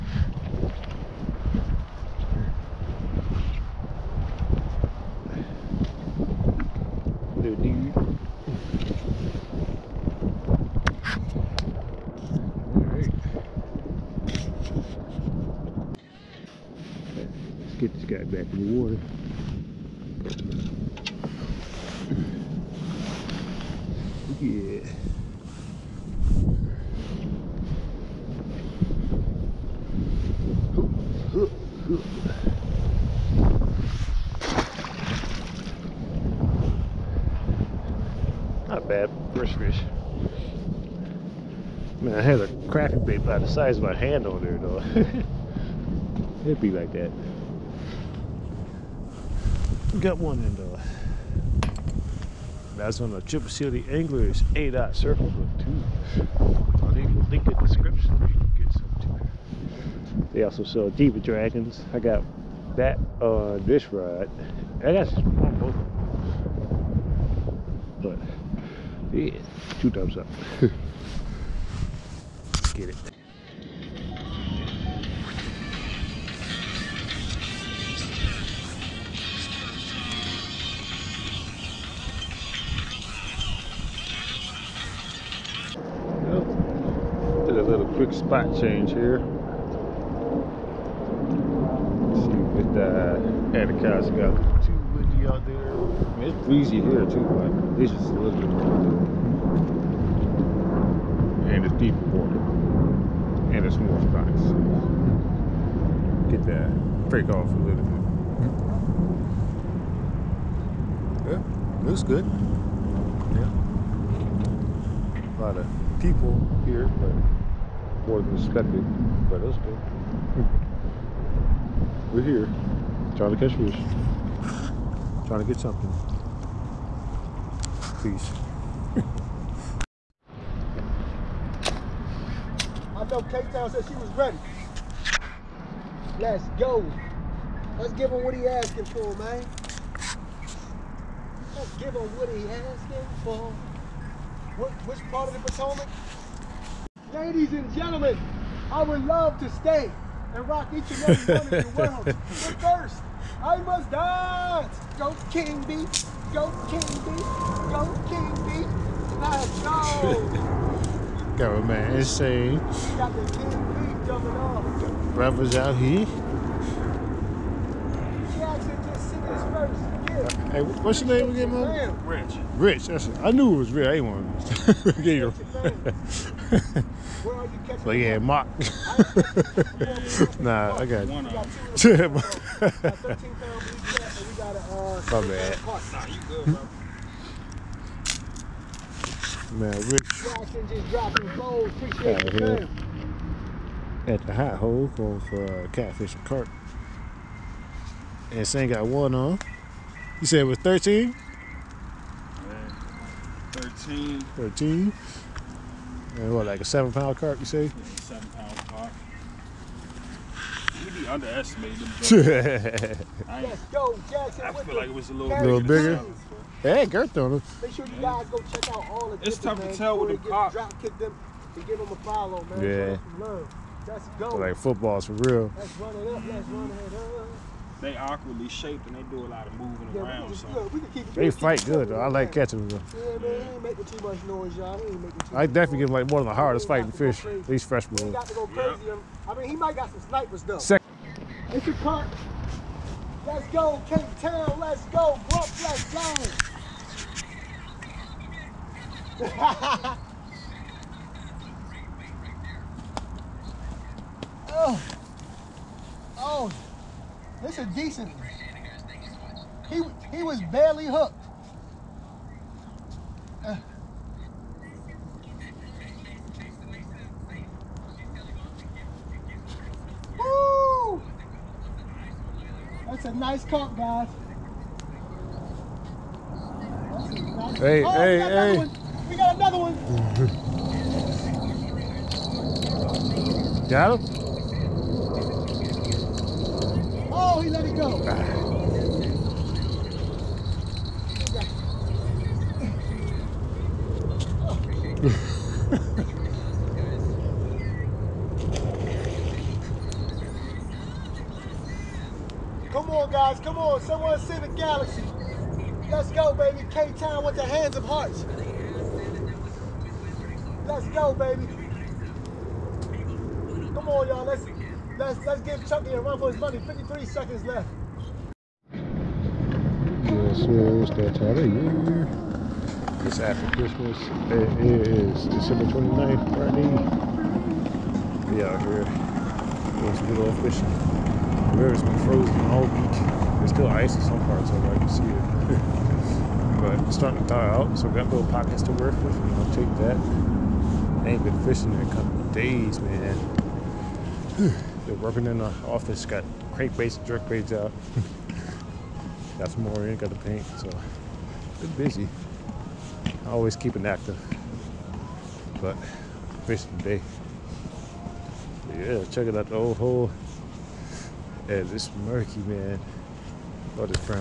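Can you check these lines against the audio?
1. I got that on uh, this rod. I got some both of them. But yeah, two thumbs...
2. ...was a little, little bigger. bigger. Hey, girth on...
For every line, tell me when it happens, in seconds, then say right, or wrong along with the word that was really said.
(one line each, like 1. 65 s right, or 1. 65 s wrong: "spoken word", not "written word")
1. 61 s right
2. 214 s right.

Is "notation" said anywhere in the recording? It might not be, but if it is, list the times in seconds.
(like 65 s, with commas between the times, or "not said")
not said.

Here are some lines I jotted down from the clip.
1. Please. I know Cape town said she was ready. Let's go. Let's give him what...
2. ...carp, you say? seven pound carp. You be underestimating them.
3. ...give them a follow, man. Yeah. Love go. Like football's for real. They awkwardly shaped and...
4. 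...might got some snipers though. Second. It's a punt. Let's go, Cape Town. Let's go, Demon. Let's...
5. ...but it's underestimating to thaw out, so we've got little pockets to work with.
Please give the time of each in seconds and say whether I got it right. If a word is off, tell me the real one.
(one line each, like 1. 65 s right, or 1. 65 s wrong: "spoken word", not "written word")
1. 127 s right
2. 207 s right
3. 221 s right
4. 239 s wrong: "Brooklyn", not "Demon"
5. 336 s wrong: "starting", not "underestimating".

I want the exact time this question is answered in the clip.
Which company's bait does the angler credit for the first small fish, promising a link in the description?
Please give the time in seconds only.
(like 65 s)
53 s.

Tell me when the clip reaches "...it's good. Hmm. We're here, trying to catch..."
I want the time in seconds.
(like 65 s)
119 s.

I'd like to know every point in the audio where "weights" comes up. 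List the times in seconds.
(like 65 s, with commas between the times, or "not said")
347 s.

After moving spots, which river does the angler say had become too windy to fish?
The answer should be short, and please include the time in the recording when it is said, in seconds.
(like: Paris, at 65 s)
Anacostia, at 93 s.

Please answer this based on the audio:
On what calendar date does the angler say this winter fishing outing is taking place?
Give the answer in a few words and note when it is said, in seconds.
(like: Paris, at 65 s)
December 29, at 325 s.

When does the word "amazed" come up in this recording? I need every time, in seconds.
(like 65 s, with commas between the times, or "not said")
not said.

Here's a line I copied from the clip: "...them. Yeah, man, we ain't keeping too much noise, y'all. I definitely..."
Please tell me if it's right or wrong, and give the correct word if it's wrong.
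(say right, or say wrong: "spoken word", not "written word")
wrong: "making", not "keeping".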